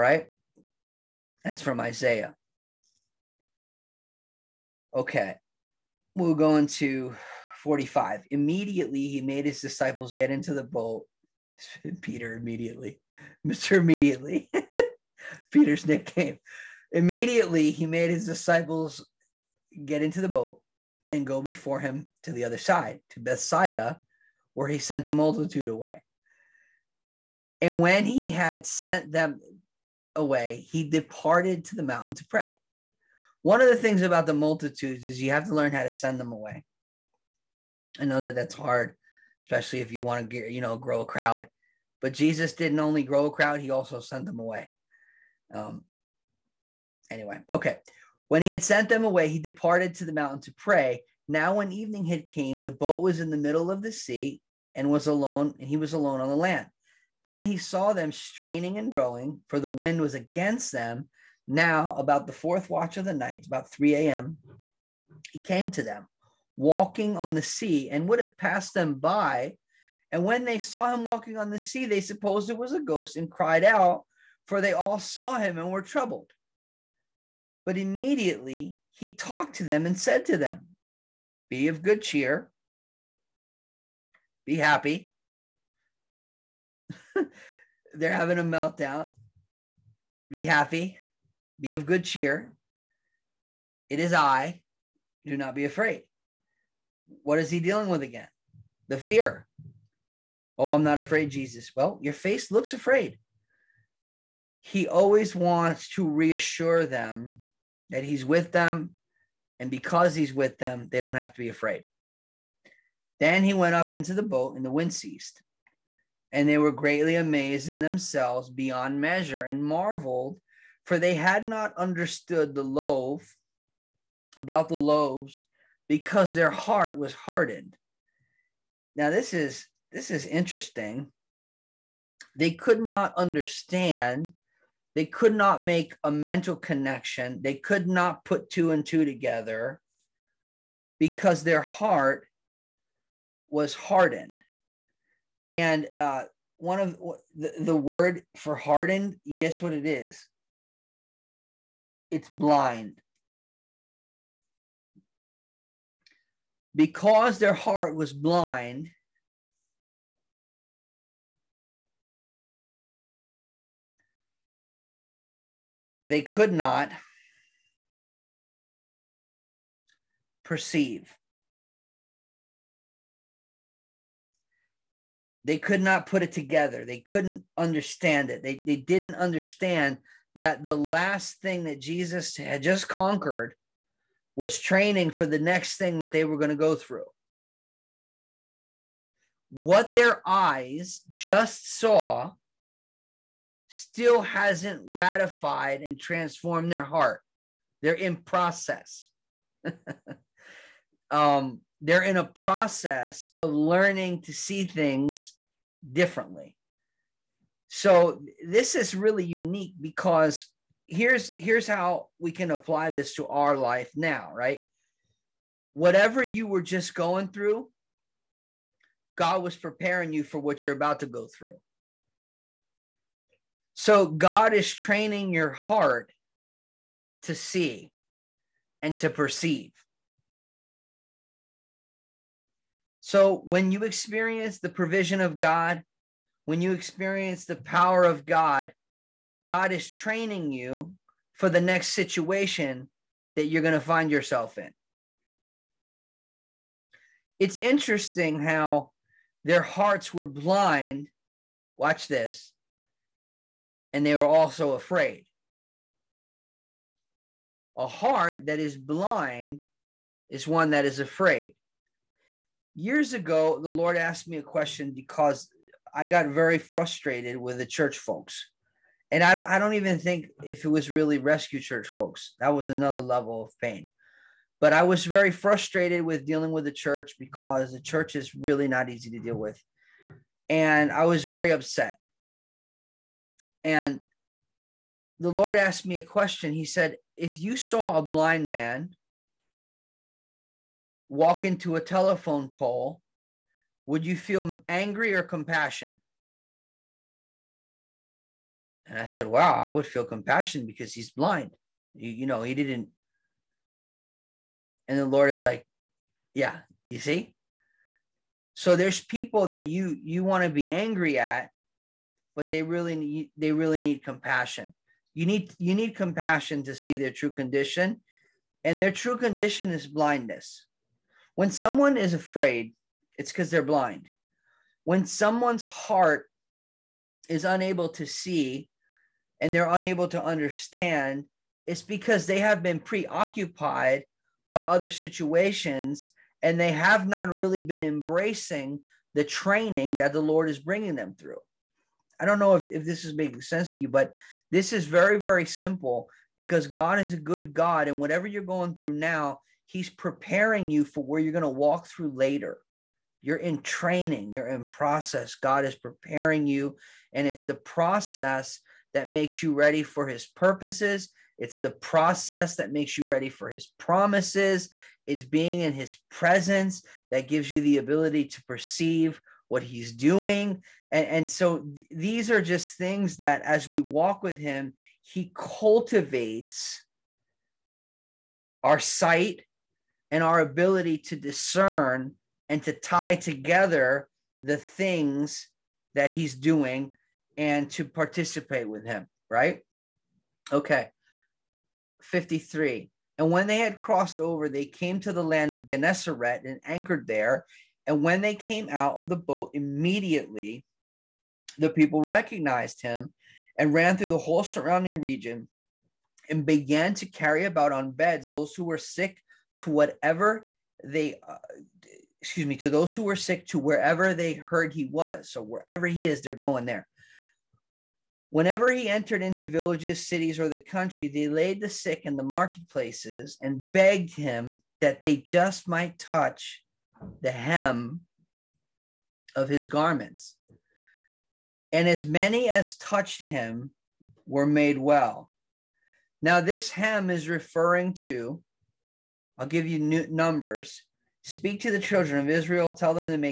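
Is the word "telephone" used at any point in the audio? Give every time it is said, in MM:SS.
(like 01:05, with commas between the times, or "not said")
04:51.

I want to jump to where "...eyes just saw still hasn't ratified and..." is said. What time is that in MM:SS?
03:10.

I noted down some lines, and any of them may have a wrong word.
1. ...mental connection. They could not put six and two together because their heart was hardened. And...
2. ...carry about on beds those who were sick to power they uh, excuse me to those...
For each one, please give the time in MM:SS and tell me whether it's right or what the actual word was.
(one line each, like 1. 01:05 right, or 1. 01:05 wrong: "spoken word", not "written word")
1. 02:16 wrong: "two", not "six"
2. 06:47 wrong: "whatever", not "power".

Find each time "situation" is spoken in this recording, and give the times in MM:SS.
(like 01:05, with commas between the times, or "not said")
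04:01, 05:34.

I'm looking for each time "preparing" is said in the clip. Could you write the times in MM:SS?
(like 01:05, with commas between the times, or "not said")
03:39, 05:49, 05:55.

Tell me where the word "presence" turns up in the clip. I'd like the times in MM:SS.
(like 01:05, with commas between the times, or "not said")
06:06.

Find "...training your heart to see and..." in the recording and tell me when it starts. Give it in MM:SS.
03:44.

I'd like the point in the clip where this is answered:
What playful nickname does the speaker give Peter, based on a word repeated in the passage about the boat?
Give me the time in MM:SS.
00:13.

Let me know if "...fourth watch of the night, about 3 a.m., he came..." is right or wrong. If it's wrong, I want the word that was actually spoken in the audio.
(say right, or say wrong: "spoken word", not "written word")
right.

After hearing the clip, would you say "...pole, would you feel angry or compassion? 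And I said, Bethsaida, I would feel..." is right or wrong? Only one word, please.
wrong.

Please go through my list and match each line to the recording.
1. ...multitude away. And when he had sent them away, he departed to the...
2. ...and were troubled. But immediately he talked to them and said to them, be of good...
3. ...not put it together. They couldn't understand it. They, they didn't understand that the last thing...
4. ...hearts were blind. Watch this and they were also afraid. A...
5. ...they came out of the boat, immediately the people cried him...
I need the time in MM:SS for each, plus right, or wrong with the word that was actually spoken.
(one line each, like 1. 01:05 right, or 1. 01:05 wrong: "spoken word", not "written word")
1. 00:25 right
2. 01:15 right
3. 02:55 right
4. 04:09 right
5. 06:38 wrong: "recognized", not "cried".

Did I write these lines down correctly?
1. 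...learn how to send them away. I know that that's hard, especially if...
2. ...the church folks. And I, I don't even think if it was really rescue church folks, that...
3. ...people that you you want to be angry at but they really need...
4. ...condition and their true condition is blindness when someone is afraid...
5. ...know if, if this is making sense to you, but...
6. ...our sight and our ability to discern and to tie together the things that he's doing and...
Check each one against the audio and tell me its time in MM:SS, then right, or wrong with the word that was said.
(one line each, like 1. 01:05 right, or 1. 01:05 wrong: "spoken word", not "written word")
1. 00:35 right
2. 04:27 right
3. 05:09 right
4. 05:17 right
5. 05:42 right
6. 06:18 right.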